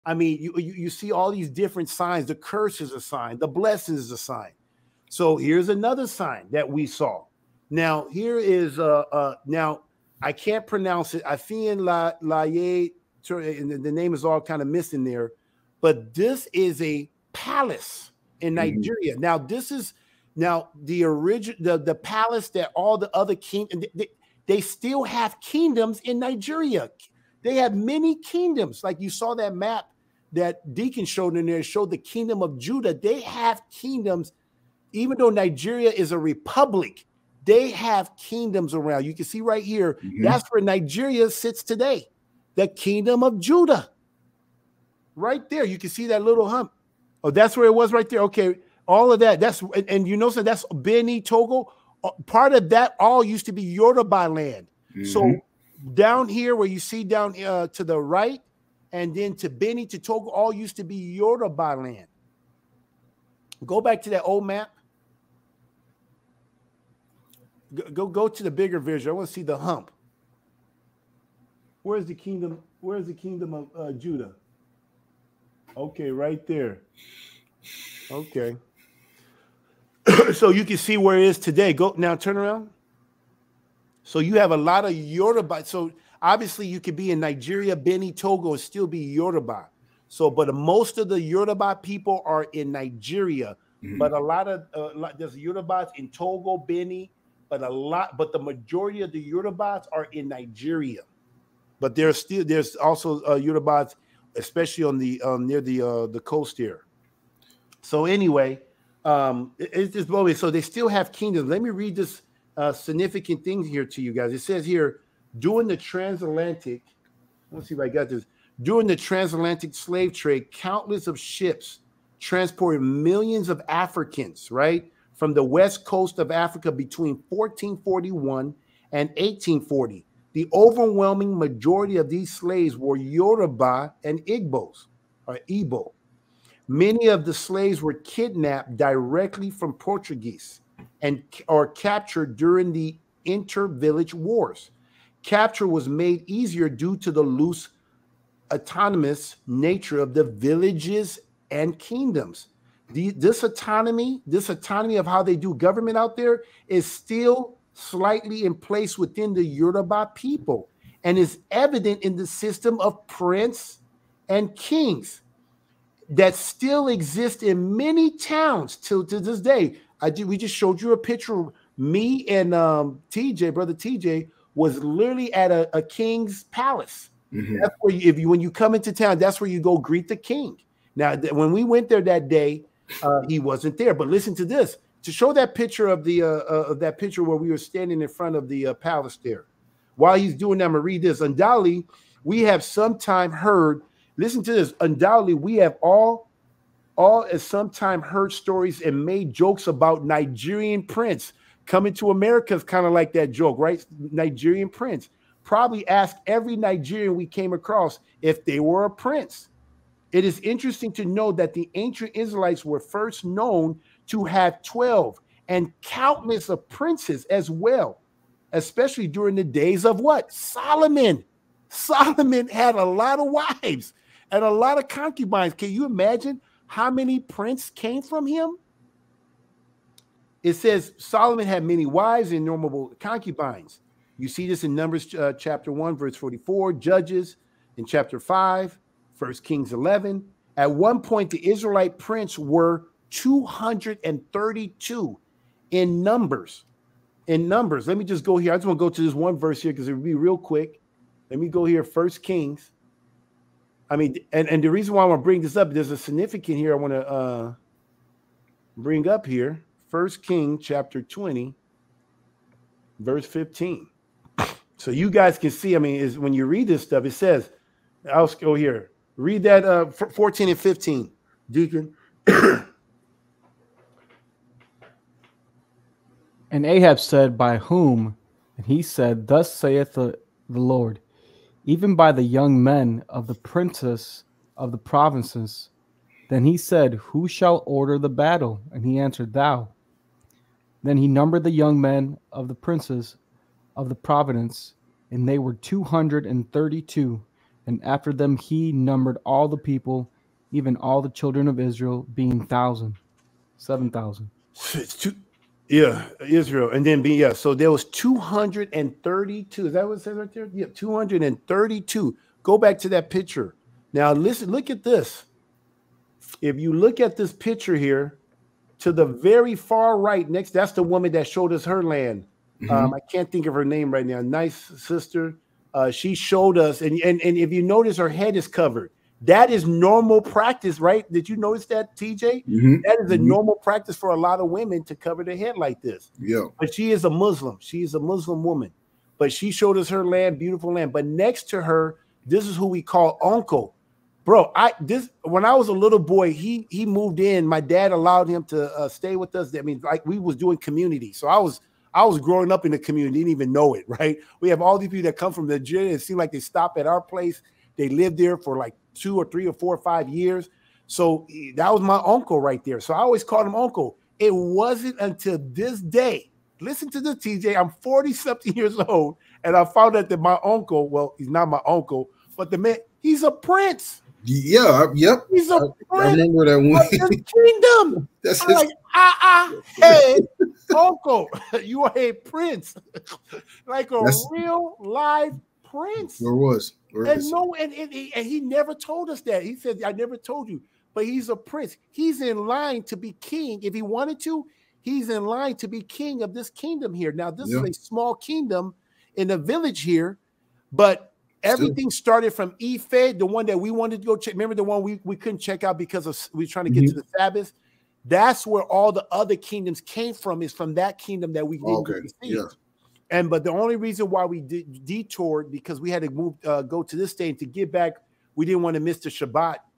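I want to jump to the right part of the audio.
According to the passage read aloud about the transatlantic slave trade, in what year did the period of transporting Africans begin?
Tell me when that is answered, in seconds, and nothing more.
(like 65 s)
127 s.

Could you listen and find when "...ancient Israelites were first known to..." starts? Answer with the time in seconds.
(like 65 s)
211 s.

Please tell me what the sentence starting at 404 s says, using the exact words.
Remember the one we, we couldn't check out because of we were trying to get mm-hmm.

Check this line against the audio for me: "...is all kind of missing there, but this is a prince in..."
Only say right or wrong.
wrong.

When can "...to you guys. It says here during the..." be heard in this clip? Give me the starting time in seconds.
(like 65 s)
113 s.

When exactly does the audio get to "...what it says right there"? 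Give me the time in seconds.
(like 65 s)
309 s.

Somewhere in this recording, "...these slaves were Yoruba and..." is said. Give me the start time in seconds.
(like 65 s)
132 s.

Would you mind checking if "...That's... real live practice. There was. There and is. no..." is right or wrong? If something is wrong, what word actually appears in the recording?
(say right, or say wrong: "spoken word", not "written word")
wrong: "prince", not "practice".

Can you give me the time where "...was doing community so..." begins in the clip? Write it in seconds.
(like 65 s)
350 s.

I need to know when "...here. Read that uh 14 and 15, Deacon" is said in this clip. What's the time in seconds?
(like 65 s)
268 s.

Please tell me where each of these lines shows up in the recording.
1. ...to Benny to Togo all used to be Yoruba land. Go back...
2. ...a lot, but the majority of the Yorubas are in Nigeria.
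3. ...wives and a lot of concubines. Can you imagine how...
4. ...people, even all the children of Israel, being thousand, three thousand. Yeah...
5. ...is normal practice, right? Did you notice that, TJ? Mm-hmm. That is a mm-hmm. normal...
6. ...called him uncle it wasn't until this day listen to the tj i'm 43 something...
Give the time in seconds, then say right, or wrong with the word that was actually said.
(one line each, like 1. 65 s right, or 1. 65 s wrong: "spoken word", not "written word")
1. 59 s right
2. 97 s right
3. 223 s right
4. 299 s wrong: "seven", not "three"
5. 329 s right
6. 363 s wrong: "40", not "43".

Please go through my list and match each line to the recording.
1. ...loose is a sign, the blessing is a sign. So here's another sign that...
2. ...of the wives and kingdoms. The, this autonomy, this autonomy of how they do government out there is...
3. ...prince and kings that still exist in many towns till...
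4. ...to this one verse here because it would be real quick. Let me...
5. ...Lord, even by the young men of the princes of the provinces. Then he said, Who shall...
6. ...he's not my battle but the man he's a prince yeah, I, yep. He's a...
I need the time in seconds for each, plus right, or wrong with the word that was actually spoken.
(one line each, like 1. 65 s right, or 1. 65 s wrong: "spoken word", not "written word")
1. 2 s wrong: "curse", not "loose"
2. 149 s wrong: "villages", not "wives"
3. 163 s right
4. 248 s right
5. 280 s right
6. 371 s wrong: "uncle", not "battle".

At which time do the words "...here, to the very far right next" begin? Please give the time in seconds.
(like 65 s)
317 s.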